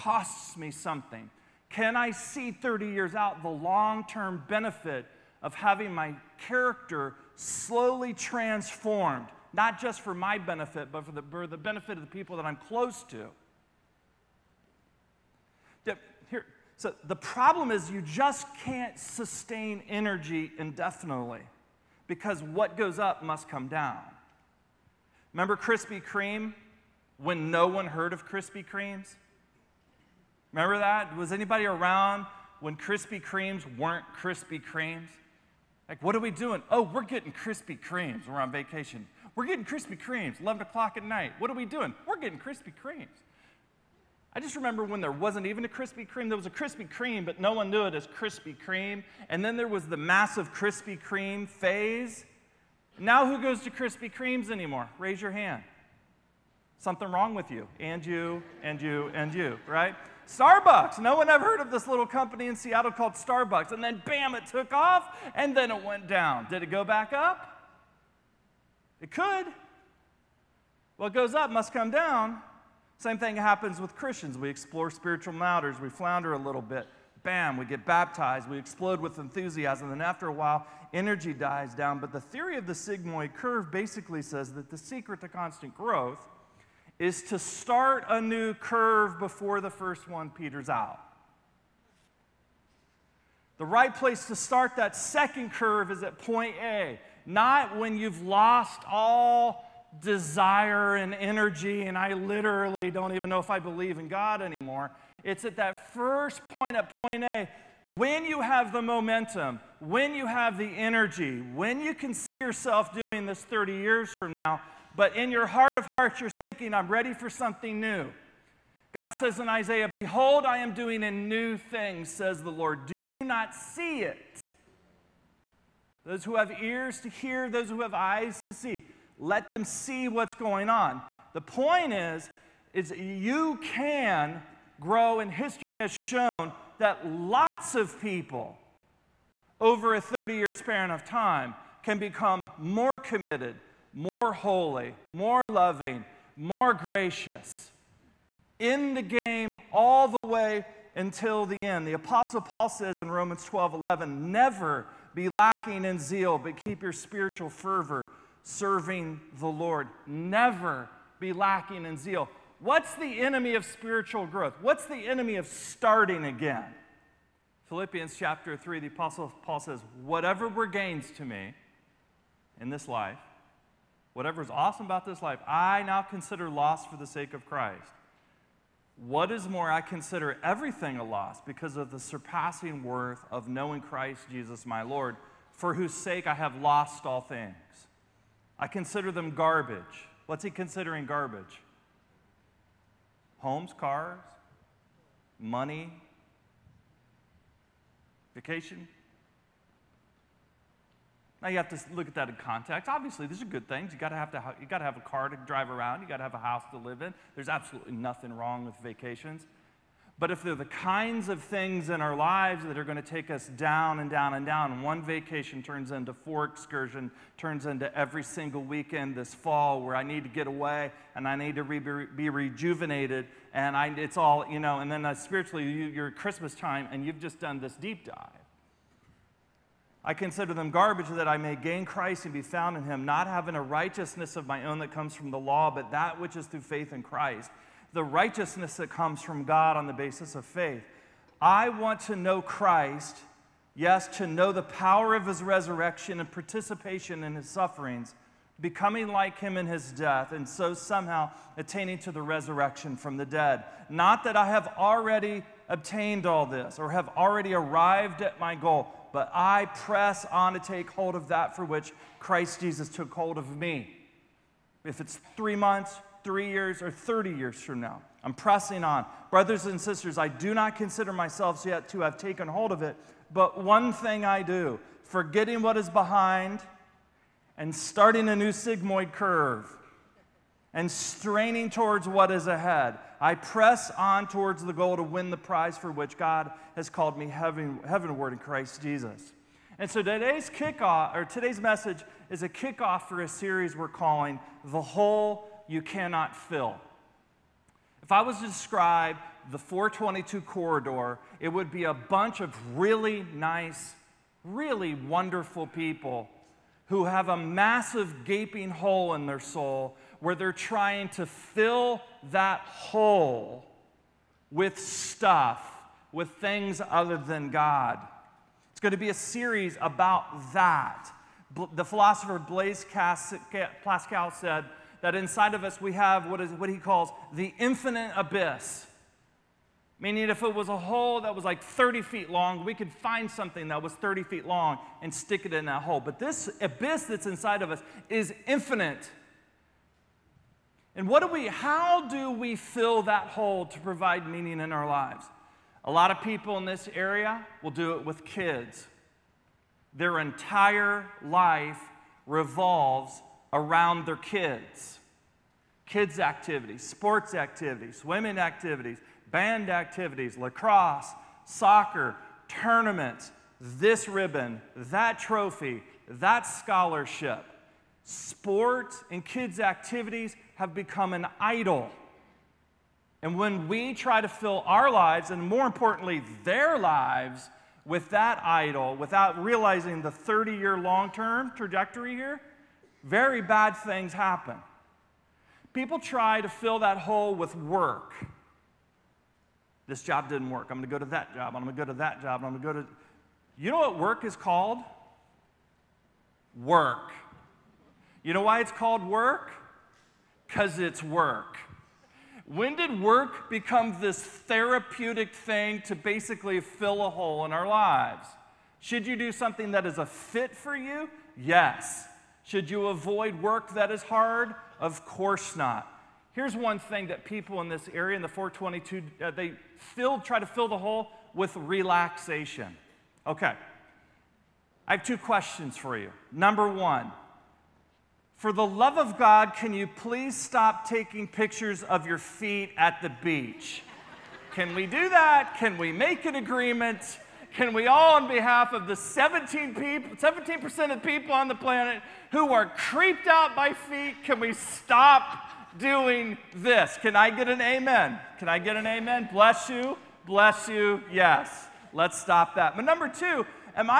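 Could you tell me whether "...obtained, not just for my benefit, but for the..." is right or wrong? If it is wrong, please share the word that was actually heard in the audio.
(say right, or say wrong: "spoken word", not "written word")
wrong: "transformed", not "obtained".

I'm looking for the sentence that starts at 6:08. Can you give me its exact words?
Sports and kids' activities have become an idol.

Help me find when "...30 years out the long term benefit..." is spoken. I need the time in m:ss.
0:02.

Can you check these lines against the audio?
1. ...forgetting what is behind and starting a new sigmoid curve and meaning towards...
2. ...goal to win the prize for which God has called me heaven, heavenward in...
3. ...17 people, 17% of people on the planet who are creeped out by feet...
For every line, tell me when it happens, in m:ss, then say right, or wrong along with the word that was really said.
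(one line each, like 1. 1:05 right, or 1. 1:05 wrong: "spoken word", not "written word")
1. 4:35 wrong: "straining", not "meaning"
2. 4:44 right
3. 7:18 right.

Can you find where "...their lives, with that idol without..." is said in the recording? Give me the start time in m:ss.
6:16.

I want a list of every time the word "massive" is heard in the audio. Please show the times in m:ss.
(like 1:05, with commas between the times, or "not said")
0:49, 5:07.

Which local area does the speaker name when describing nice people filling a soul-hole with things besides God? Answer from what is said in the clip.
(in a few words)
422 corridor.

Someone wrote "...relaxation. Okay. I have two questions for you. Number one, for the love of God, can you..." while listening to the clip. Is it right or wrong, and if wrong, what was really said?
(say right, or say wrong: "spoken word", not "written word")
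right.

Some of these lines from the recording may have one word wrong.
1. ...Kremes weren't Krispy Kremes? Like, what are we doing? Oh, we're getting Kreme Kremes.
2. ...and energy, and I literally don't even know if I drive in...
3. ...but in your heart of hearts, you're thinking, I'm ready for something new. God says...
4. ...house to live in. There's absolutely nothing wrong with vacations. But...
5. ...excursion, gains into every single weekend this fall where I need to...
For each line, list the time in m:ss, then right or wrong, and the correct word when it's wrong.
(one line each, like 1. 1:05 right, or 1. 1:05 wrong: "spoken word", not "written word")
1. 0:33 wrong: "Krispy", not "Kreme"
2. 1:40 wrong: "believe", not "drive"
3. 1:54 right
4. 3:26 right
5. 3:36 wrong: "turns", not "gains".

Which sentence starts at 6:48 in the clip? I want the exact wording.
Should you do something that is a fit for you?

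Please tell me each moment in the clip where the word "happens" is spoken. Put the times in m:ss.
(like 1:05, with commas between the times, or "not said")
1:13, 6:24.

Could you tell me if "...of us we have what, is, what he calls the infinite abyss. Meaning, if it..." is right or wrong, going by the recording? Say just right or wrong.
right.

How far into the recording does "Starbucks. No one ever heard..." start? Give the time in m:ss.
1:00.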